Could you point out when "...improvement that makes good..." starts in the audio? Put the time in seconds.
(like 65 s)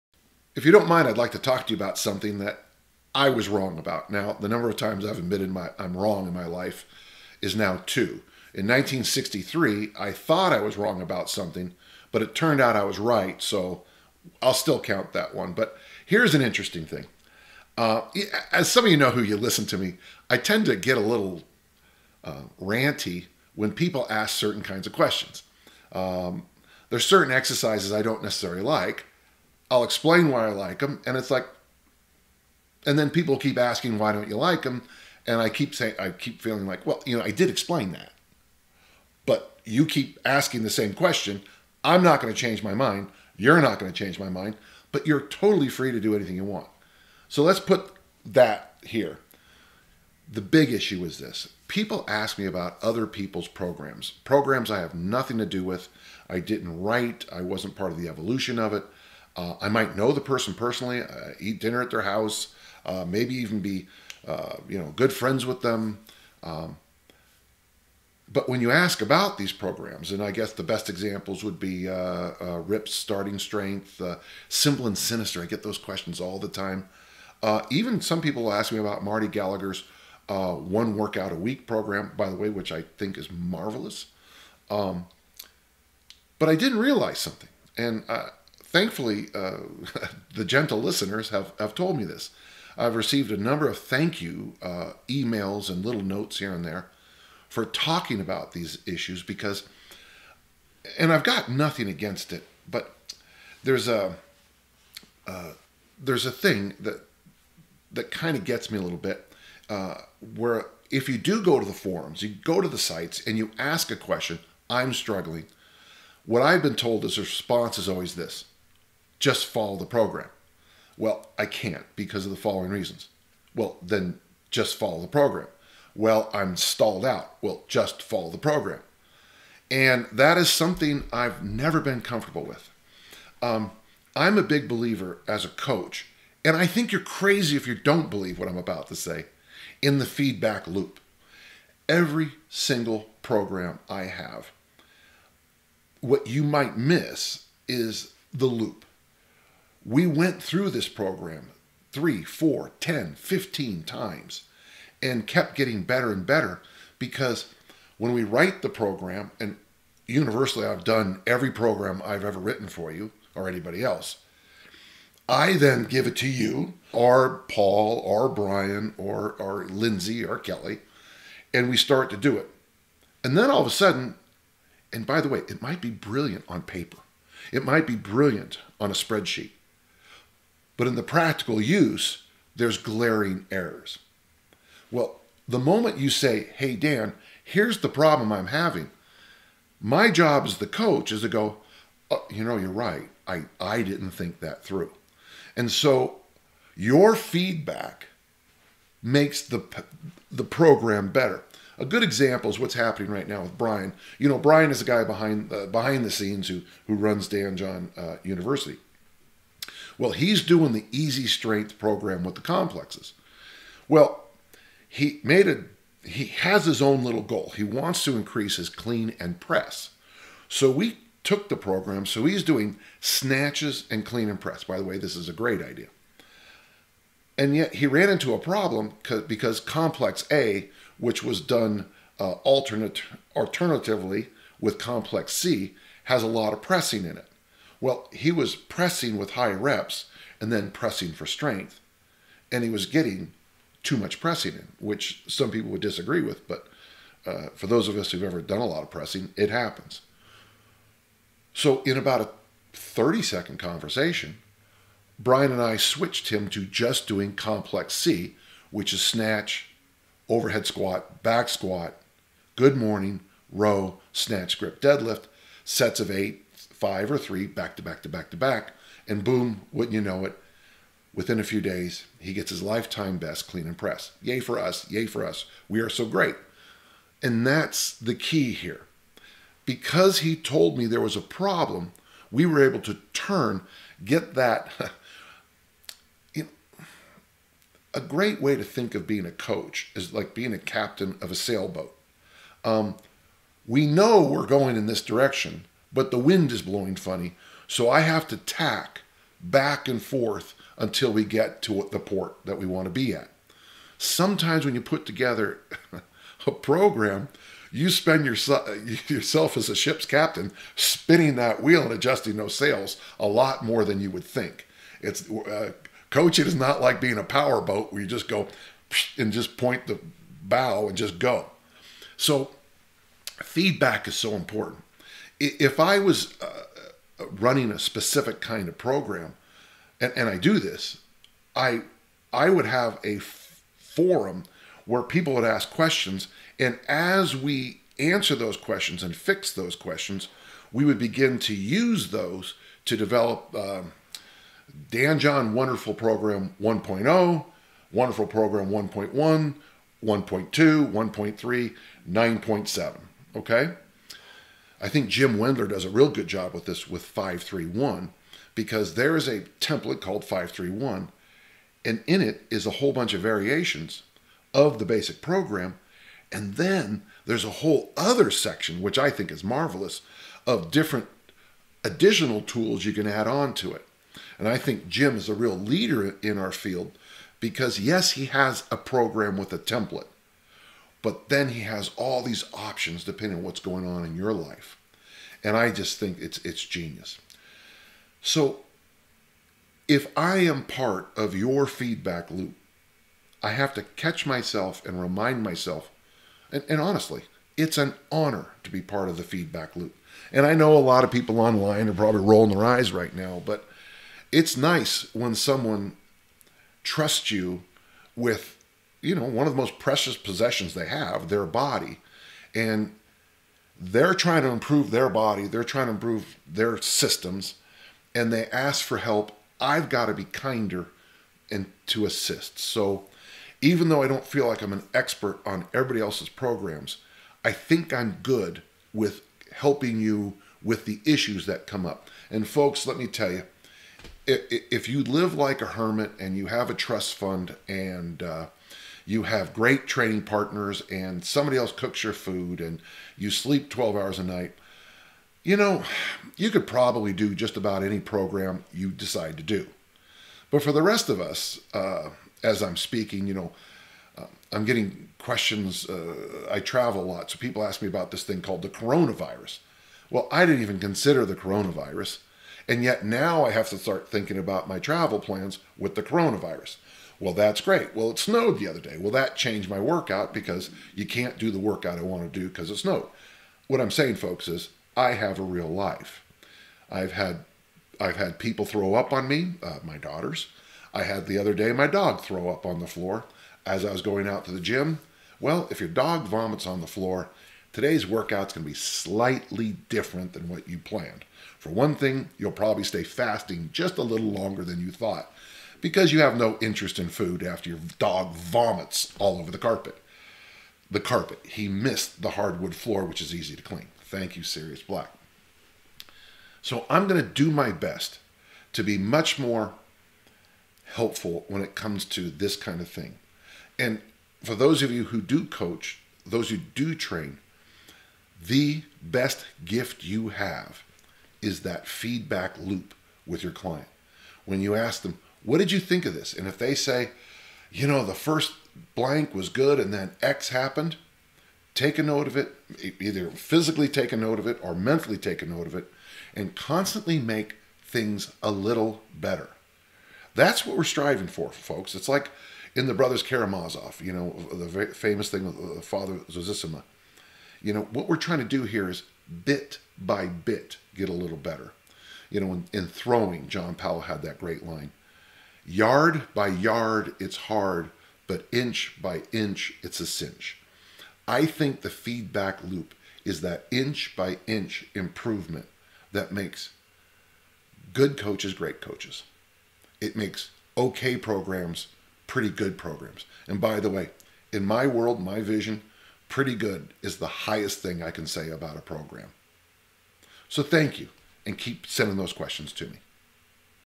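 564 s.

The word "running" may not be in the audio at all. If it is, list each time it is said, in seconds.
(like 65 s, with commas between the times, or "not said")
327 s.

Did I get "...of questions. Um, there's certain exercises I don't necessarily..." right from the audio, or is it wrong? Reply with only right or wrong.
right.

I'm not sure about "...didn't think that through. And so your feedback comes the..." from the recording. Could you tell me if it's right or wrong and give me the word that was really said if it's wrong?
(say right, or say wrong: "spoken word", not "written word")
wrong: "makes", not "comes".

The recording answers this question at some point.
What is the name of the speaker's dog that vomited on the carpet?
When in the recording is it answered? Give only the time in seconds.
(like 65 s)
504 s.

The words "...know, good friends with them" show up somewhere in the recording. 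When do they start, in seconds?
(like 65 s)
64 s.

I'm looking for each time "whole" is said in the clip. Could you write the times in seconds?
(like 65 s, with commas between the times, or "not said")
362 s, 367 s.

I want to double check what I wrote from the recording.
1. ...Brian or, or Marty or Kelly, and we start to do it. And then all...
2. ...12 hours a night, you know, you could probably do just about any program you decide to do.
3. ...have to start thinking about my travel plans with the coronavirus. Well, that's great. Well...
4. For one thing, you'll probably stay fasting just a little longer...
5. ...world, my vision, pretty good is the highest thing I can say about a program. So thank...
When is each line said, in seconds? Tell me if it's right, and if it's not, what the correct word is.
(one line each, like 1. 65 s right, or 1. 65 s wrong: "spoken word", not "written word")
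1. 168 s wrong: "Lindsay", not "Marty"
2. 443 s right
3. 463 s right
4. 491 s right
5. 574 s right.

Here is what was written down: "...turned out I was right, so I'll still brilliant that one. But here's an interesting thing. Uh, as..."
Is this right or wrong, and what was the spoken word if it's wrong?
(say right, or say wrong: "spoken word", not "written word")
wrong: "count", not "brilliant".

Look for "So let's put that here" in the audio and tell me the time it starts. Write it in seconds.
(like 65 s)
47 s.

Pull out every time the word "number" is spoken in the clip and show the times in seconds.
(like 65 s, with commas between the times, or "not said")
4 s, 93 s.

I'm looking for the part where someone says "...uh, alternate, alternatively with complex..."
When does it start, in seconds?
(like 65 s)
232 s.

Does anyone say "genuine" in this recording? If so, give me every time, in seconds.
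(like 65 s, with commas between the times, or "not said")
not said.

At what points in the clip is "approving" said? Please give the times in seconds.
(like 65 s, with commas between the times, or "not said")
not said.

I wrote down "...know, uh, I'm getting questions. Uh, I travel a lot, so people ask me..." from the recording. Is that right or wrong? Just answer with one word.
right.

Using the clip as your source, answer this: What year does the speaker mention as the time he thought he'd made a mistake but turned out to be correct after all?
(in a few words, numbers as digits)
1963.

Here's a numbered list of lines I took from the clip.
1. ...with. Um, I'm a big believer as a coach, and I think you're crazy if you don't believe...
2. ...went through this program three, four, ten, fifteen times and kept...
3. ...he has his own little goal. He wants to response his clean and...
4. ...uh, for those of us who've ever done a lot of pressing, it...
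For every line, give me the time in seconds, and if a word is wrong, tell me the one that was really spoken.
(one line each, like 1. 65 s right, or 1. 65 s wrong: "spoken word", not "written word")
1. 132 s right
2. 150 s right
3. 216 s wrong: "increase", not "response"
4. 247 s right.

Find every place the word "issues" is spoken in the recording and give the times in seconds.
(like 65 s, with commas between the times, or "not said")
50 s, 98 s, 431 s.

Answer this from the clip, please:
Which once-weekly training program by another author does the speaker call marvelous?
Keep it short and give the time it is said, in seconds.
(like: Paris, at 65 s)
One Workout a Week, at 80 s.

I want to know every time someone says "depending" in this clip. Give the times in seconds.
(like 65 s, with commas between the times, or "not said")
383 s.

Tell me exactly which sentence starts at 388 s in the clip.
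So if I am part of your feedback loop, I have to catch myself and remind myself.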